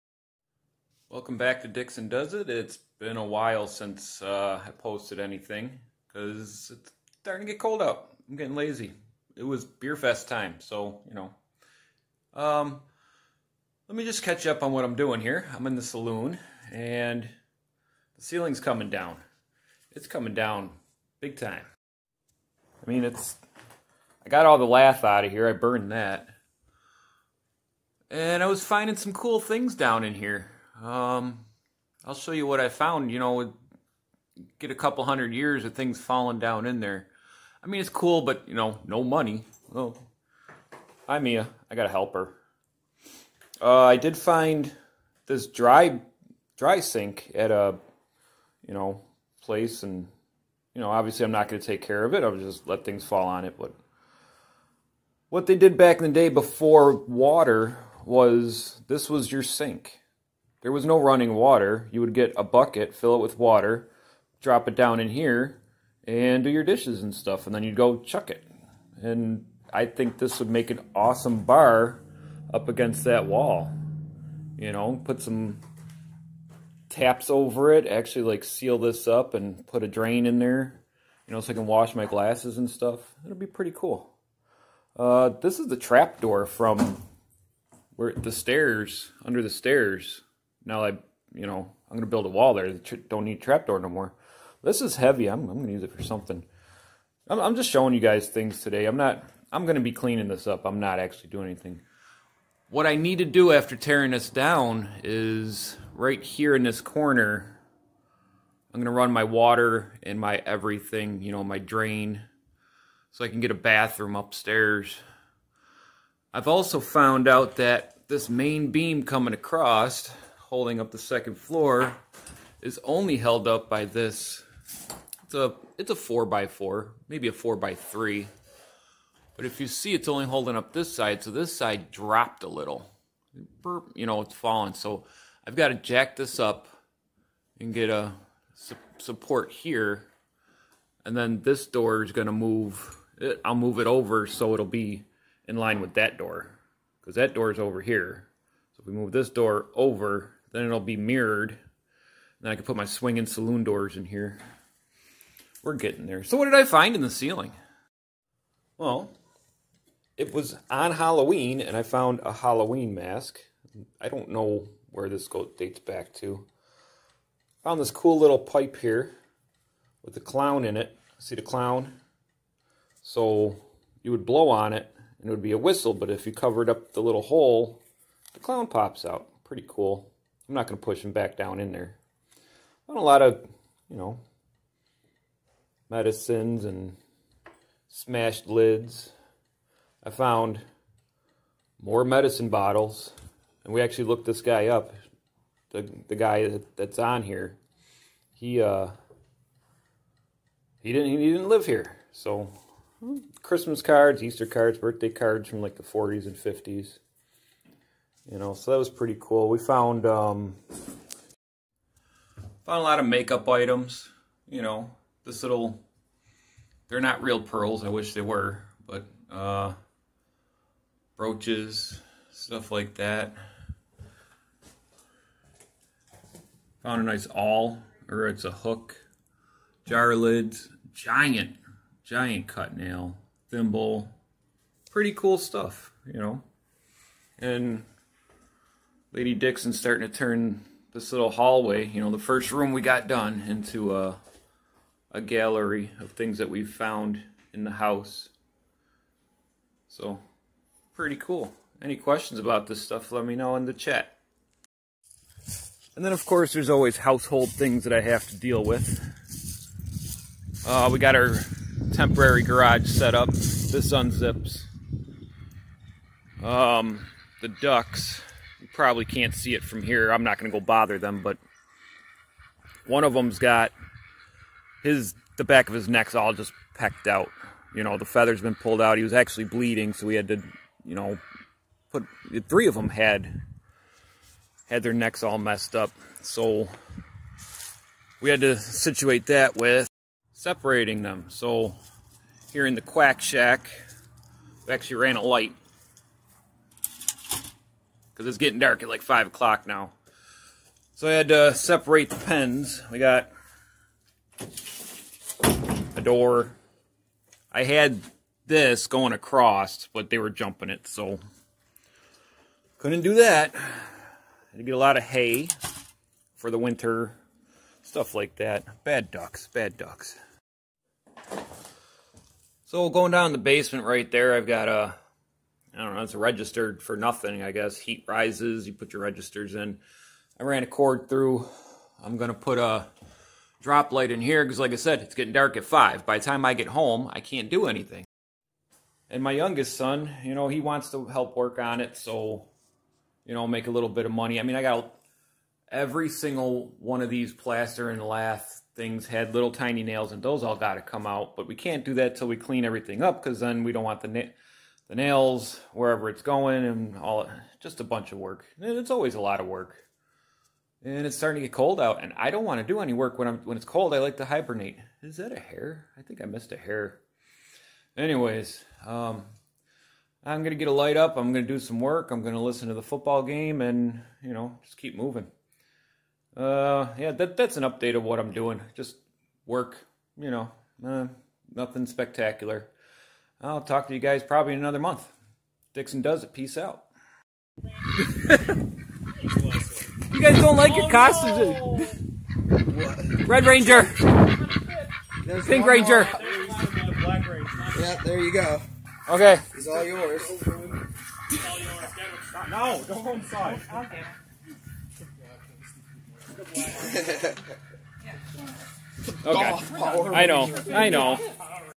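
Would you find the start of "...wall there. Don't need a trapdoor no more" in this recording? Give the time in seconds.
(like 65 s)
92 s.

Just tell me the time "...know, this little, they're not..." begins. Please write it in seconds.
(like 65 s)
214 s.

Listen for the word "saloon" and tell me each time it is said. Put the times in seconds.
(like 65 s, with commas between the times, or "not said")
15 s, 153 s.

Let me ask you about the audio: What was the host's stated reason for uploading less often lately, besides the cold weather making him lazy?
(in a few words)
beer fest.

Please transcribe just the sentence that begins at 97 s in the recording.
I'm, I'm just showing you guys things today.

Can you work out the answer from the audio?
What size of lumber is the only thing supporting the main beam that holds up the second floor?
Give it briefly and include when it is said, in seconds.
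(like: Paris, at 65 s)
four by four, at 125 s.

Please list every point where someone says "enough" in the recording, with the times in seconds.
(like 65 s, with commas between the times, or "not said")
not said.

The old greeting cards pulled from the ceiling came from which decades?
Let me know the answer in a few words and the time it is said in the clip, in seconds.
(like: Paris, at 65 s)
40s and 50s, at 205 s.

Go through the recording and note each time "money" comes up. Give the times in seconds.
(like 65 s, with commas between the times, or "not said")
39 s, 344 s.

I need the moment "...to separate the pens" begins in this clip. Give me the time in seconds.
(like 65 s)
301 s.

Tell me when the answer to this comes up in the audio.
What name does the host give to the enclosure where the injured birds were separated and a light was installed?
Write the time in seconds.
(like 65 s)
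292 s.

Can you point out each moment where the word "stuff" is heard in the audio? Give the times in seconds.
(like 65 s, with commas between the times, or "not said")
67 s, 82 s, 222 s, 235 s, 252 s, 317 s.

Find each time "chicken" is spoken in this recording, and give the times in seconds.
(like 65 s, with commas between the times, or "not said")
not said.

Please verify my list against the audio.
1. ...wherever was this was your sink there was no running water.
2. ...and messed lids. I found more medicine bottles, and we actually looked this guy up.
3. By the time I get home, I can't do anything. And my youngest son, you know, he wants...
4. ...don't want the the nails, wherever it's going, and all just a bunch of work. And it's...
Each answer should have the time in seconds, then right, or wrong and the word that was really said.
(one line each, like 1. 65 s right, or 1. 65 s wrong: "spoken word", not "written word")
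1. 56 s wrong: "water", not "wherever"
2. 186 s wrong: "smashed", not "messed"
3. 336 s right
4. 353 s right.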